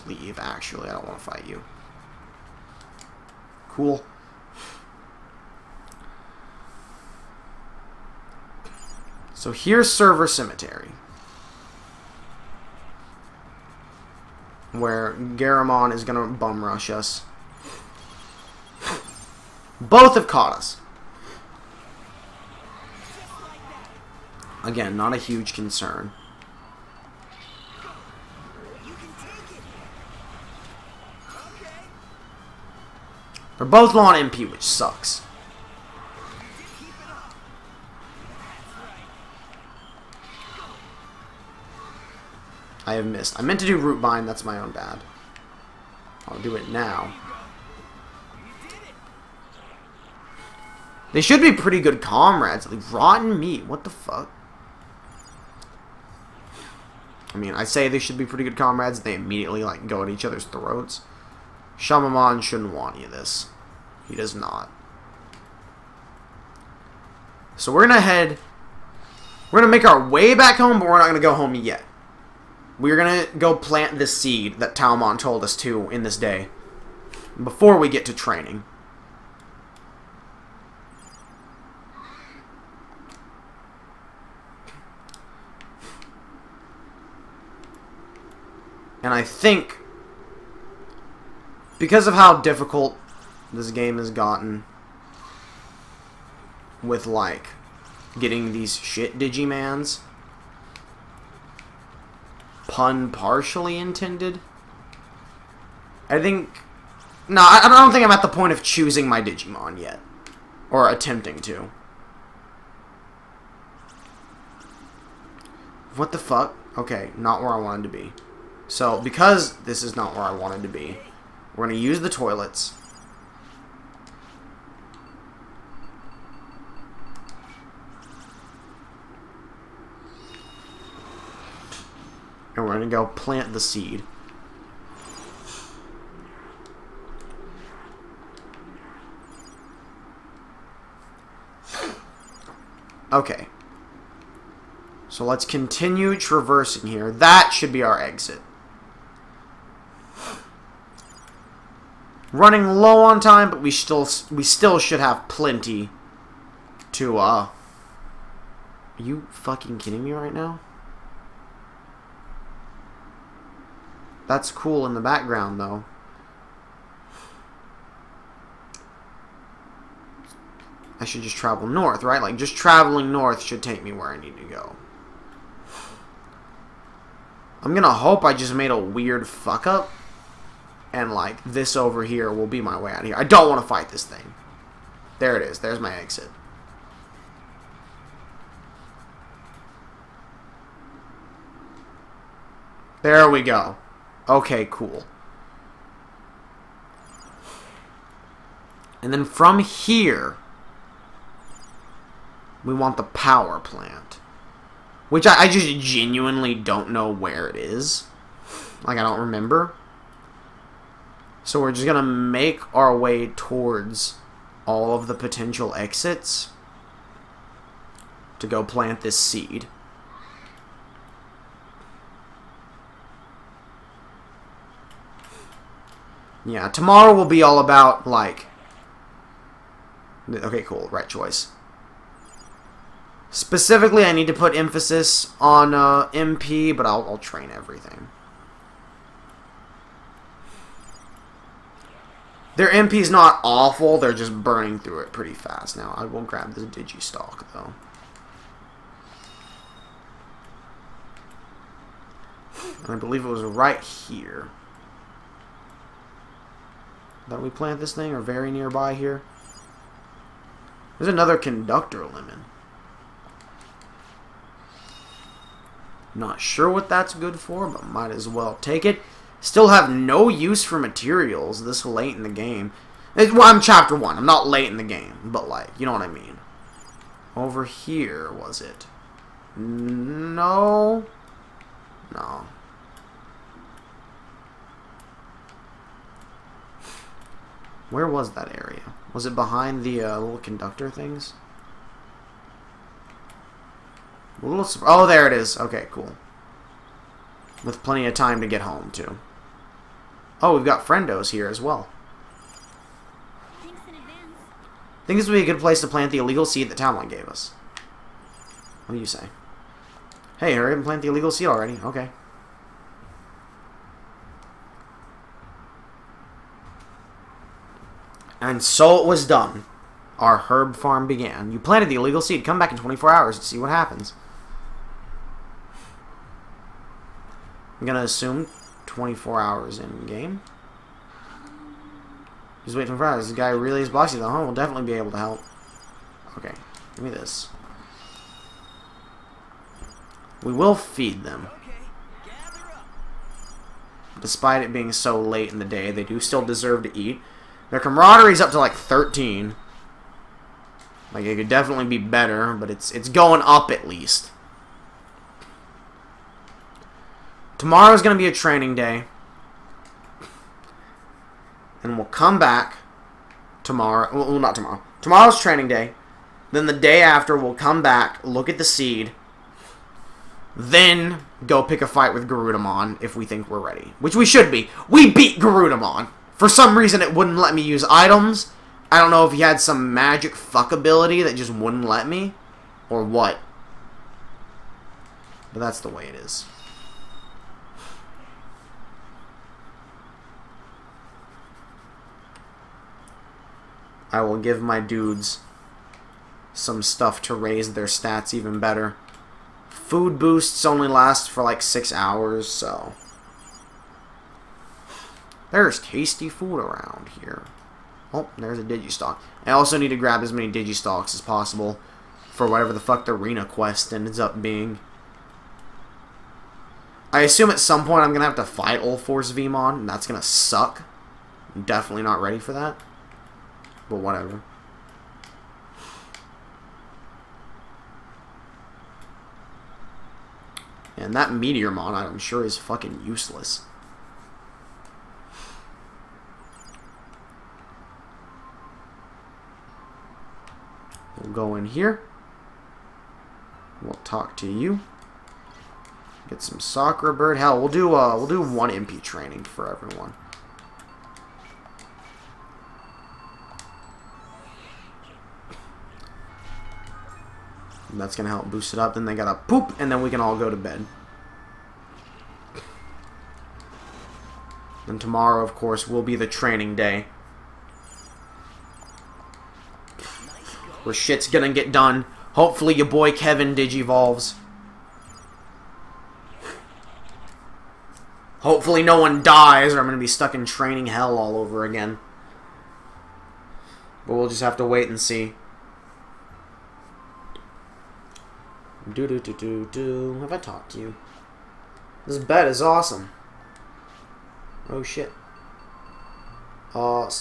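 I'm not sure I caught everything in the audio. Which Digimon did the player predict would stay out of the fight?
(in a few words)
Shamamon.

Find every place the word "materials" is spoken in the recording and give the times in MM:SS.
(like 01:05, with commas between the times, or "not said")
04:30.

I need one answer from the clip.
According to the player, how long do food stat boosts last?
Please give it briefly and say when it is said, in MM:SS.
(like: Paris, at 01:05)
6 hours, at 06:41.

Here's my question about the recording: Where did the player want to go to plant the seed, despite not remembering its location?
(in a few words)
The power plant.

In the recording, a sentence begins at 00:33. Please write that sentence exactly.
They're both on MP, which sucks.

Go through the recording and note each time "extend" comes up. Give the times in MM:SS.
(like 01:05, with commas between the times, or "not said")
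not said.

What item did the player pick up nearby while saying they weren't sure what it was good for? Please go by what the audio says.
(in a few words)
Conductor lemon.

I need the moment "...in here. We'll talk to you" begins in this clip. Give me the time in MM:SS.
07:21.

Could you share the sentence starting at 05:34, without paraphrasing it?
We'll definitely be able to help.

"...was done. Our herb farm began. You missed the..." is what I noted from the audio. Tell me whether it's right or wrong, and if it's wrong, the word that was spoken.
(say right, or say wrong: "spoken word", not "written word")
wrong: "planted", not "missed".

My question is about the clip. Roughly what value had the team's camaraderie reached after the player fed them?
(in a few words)
13.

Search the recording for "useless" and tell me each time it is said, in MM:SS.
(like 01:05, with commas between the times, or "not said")
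07:13.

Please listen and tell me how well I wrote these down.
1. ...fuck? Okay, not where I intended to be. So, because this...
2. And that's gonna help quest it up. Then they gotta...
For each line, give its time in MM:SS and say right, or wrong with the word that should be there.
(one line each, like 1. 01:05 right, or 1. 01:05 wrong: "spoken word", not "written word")
1. 01:56 wrong: "wanted", not "intended"
2. 07:37 wrong: "boost", not "quest".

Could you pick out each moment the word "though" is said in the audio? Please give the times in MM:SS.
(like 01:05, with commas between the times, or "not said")
02:45, 04:07, 05:34.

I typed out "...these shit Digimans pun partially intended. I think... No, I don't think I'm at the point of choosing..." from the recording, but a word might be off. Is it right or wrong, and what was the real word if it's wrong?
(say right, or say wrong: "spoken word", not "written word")
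right.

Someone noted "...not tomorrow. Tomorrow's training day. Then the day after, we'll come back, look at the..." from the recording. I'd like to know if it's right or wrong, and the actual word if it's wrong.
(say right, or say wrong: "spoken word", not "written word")
right.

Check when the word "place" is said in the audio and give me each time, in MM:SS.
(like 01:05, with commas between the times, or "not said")
05:05.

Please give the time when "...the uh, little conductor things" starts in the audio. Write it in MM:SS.
04:49.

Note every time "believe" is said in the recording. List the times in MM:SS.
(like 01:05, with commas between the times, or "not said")
04:12.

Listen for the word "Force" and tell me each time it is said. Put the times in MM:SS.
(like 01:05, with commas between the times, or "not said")
06:59.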